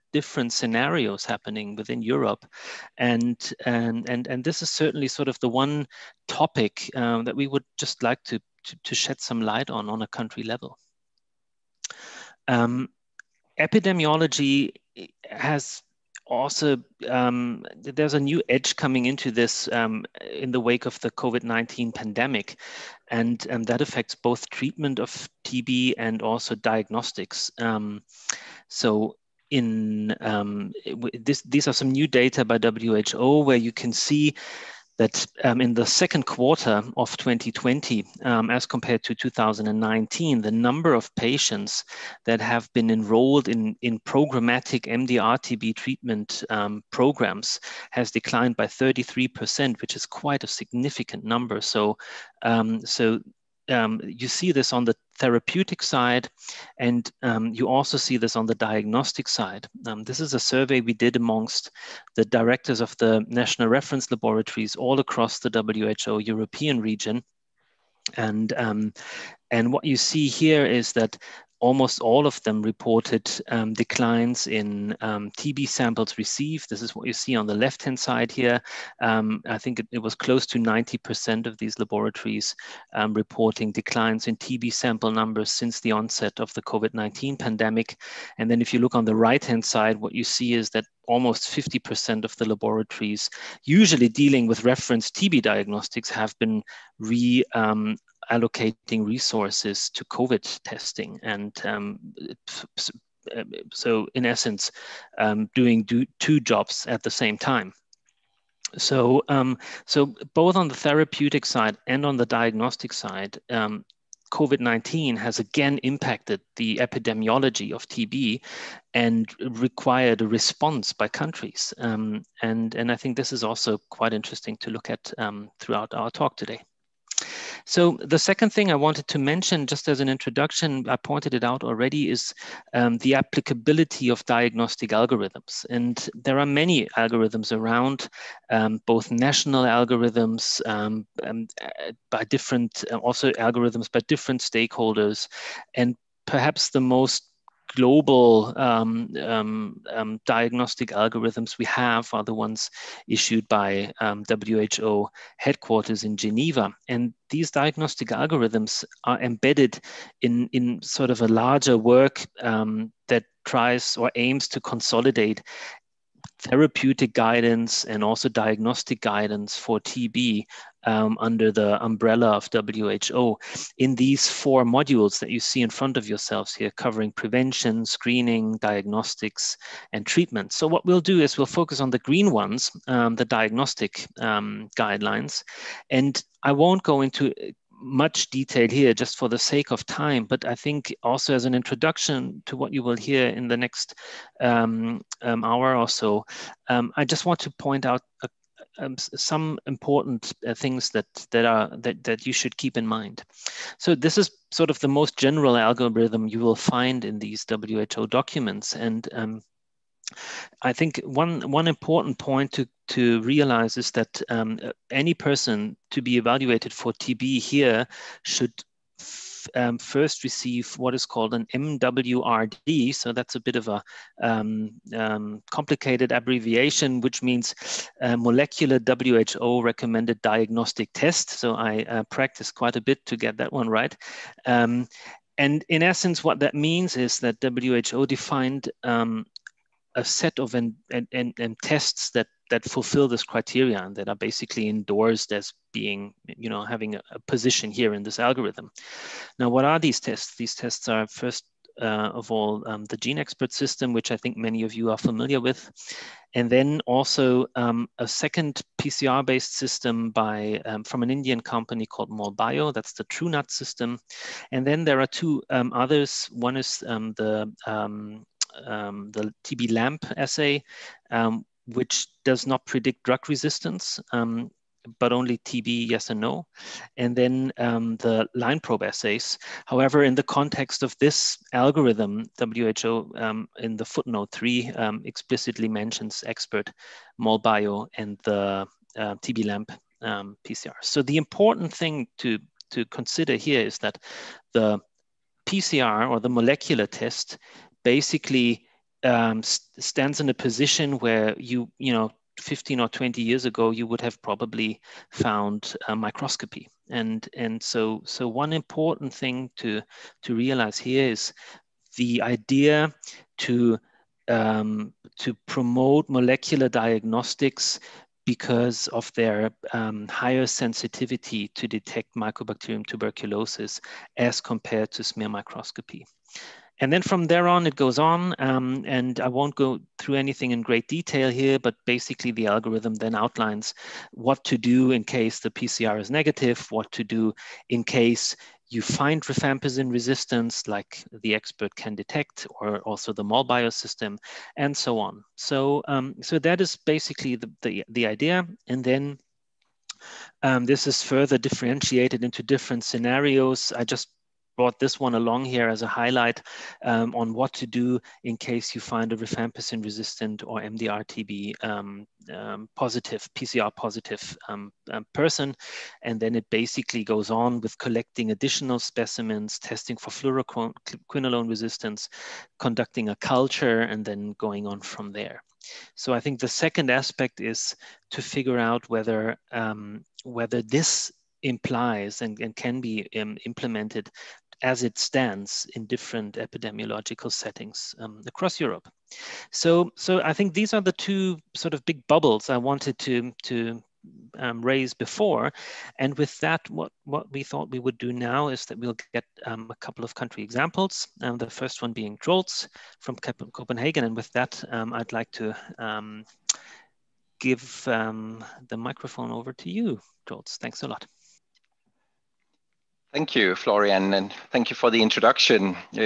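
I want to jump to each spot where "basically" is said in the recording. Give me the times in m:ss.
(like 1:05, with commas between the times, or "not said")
4:04, 4:57, 5:31, 5:46, 6:06.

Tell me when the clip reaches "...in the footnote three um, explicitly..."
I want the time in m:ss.
4:43.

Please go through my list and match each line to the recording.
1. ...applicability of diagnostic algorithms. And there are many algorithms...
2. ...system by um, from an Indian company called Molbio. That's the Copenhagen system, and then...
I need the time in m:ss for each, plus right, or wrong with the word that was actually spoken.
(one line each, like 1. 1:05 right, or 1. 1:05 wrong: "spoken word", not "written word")
1. 2:13 right
2. 4:19 wrong: "Truenat", not "Copenhagen".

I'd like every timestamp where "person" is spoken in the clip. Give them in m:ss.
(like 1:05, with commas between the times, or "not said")
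3:35, 6:05.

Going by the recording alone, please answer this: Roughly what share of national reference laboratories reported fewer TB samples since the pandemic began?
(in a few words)
90%.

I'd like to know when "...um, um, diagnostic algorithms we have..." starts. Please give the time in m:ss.
2:29.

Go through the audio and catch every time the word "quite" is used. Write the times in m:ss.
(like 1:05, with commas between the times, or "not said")
0:50, 2:03, 3:52.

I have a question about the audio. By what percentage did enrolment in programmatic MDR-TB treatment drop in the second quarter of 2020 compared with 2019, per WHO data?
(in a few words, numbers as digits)
33%.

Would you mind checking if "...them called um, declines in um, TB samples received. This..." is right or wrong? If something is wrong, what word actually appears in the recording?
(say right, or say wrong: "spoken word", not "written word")
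wrong: "reported", not "called".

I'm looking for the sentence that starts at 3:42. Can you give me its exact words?
So that's a bit of a um, um complicated abbreviation, which means uh, molecular WHO recommended diagnostic test.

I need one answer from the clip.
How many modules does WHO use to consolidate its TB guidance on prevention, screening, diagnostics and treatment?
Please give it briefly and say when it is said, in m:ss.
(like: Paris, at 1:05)
4, at 2:54.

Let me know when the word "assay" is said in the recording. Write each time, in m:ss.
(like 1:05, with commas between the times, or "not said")
4:30, 4:38.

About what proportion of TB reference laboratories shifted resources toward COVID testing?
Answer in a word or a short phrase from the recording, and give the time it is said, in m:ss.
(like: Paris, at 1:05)
50%, at 1:31.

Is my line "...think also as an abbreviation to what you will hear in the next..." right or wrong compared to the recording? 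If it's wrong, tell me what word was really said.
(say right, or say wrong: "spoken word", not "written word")
wrong: "introduction", not "abbreviation".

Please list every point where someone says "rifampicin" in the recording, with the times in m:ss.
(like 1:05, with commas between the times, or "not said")
5:39, 5:59.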